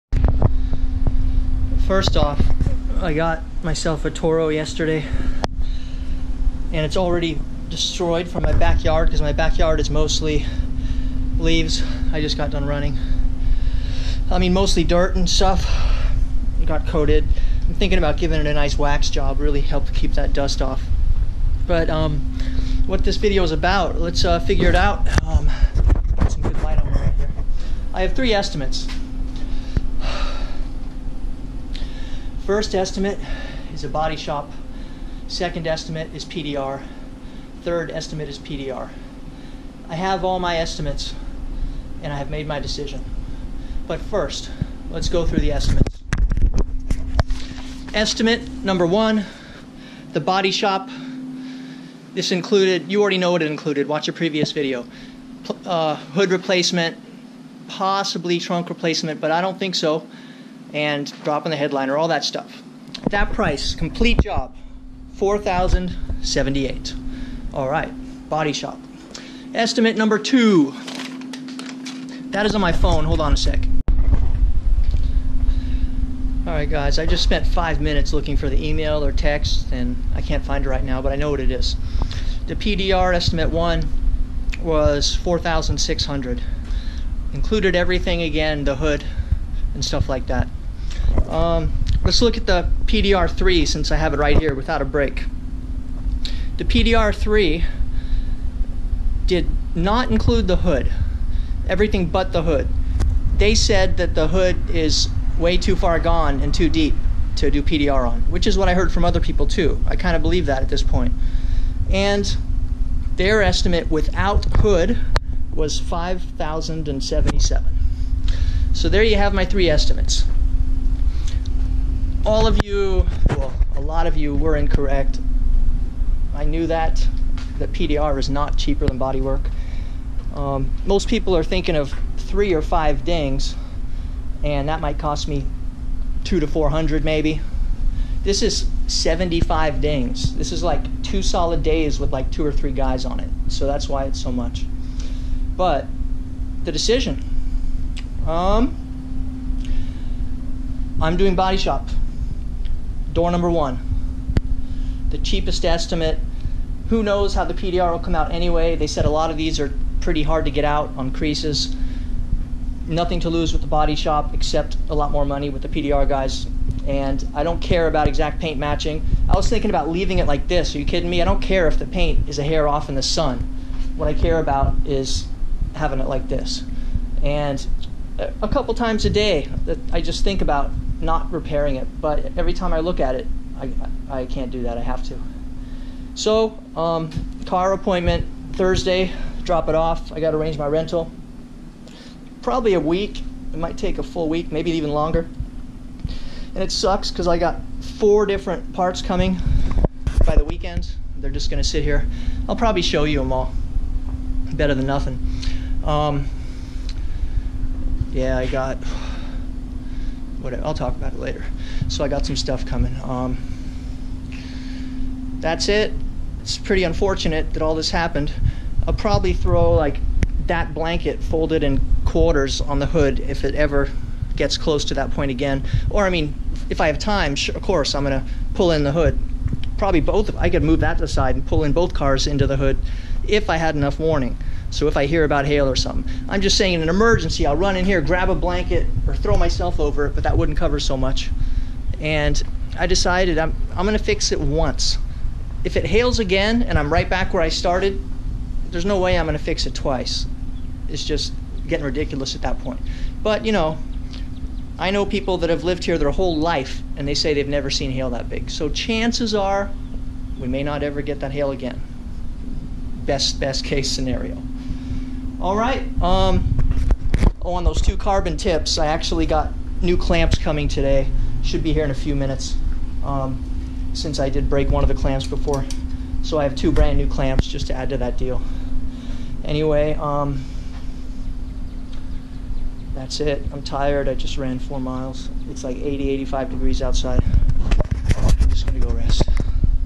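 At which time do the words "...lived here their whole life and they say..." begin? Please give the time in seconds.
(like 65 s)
255 s.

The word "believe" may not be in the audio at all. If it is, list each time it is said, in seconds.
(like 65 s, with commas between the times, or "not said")
110 s.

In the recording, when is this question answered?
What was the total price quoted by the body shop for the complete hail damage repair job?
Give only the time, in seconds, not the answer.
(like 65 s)
65 s.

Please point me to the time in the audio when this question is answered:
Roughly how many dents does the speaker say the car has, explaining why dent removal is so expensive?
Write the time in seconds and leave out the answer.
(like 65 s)
138 s.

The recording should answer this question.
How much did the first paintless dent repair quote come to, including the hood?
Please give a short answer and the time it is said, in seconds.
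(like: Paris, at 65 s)
$4,600, at 85 s.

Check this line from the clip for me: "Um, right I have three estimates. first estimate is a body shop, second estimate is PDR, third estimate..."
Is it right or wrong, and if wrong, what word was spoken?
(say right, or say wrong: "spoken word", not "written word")
right.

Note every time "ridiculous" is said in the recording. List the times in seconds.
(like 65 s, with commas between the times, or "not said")
251 s.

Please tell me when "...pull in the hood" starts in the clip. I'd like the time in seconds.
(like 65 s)
228 s.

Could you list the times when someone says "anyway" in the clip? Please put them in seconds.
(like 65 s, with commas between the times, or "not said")
158 s, 279 s.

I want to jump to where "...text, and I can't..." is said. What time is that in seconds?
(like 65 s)
79 s.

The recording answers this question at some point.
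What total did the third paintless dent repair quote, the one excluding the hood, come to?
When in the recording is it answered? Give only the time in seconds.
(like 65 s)
115 s.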